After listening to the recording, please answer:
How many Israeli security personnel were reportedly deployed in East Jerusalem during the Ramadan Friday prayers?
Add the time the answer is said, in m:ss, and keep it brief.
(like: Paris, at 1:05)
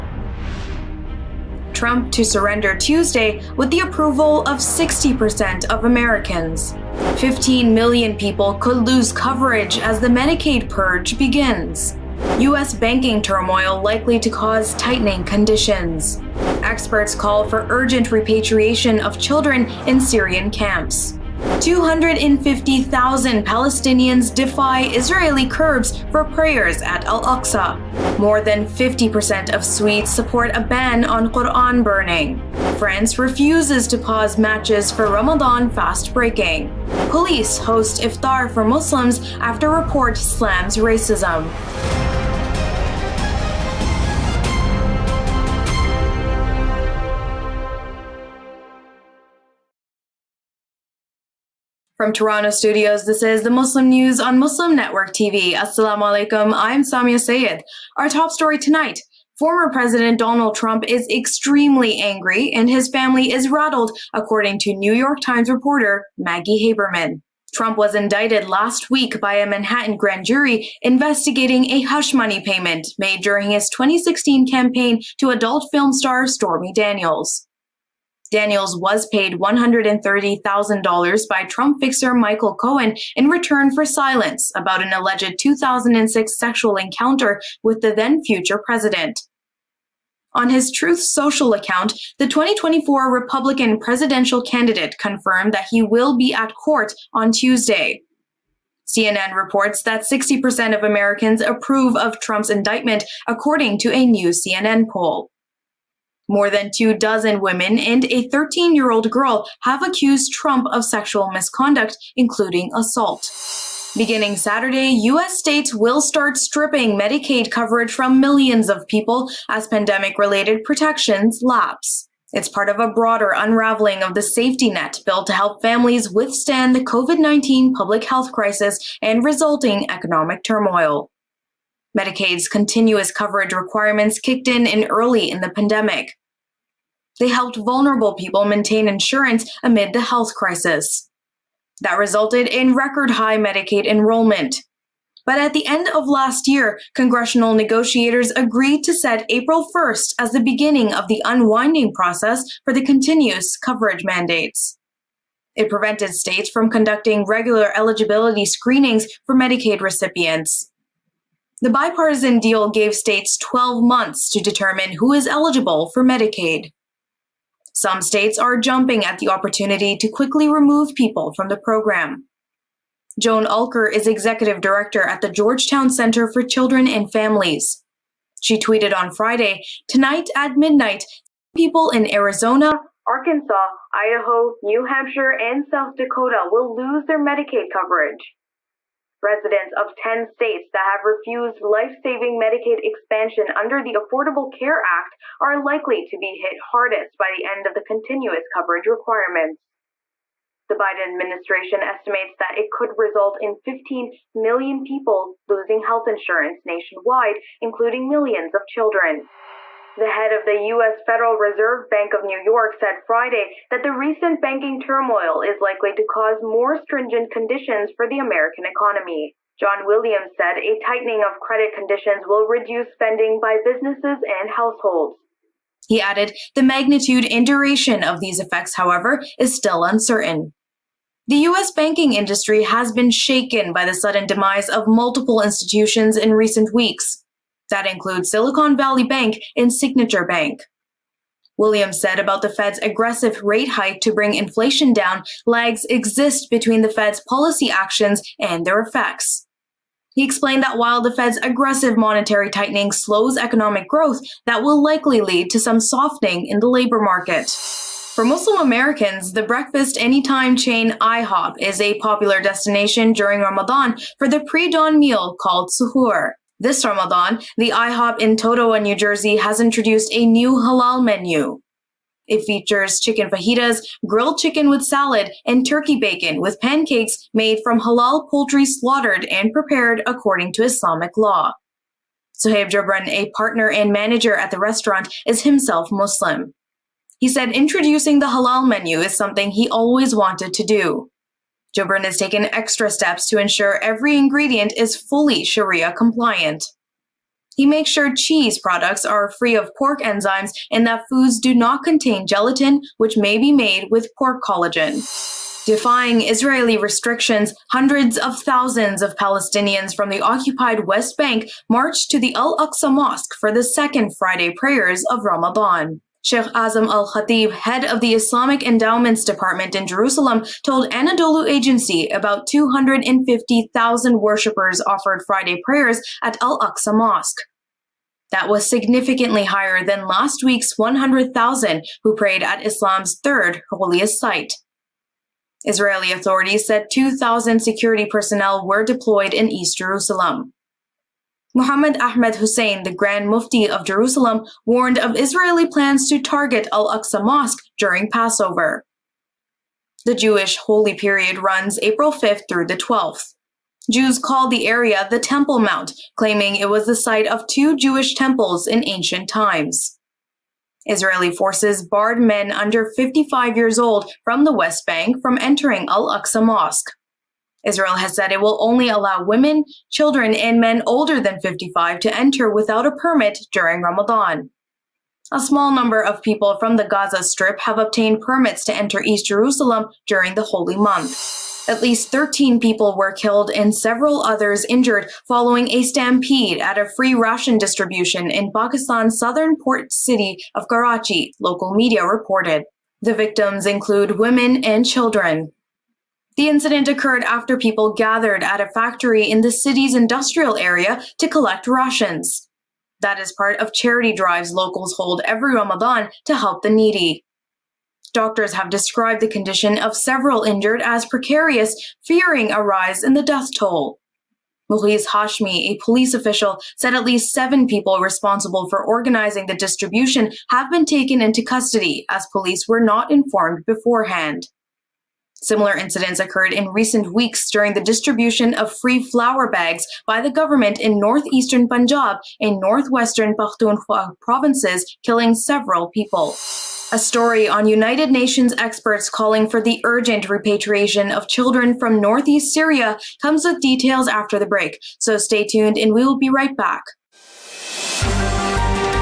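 2,000, at 5:36.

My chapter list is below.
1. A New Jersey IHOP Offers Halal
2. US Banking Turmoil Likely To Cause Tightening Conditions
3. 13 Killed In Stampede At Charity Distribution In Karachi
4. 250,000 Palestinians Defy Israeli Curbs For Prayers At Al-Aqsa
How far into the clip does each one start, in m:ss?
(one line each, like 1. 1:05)
1. 4:17
2. 3:29
3. 6:21
4. 5:05.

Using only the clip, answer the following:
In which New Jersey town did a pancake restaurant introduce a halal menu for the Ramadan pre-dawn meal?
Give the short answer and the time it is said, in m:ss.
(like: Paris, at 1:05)
Totowa, at 4:28.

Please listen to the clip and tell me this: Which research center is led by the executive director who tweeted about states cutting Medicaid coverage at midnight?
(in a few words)
Georgetown Center for Children and Families.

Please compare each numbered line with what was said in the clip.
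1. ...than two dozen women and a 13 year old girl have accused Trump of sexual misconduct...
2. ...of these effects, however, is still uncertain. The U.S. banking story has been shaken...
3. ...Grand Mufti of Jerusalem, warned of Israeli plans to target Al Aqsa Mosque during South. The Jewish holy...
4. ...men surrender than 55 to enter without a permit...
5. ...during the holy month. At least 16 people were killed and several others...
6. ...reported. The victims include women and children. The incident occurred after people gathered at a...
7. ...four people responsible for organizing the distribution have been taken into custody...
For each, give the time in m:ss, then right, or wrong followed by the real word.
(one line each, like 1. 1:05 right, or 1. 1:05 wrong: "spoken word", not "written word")
1. 1:46 right
2. 3:48 wrong: "industry", not "story"
3. 5:42 wrong: "Passover", not "South"
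4. 6:10 wrong: "older", not "surrender"
5. 6:20 wrong: "13", not "16"
6. 6:32 right
7. 6:57 wrong: "seven", not "four".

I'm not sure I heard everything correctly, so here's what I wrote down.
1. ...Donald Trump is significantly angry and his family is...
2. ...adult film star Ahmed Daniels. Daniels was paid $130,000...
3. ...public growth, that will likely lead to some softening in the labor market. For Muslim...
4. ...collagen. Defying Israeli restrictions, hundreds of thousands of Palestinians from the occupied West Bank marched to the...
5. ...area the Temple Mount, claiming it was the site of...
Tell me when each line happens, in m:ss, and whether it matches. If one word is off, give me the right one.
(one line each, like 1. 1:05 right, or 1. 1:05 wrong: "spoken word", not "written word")
1. 1:00 wrong: "extremely", not "significantly"
2. 1:15 wrong: "Stormy", not "Ahmed"
3. 4:13 wrong: "economic", not "public"
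4. 5:04 right
5. 5:54 right.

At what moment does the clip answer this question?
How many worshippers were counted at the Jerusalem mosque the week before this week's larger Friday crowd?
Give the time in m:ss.
5:30.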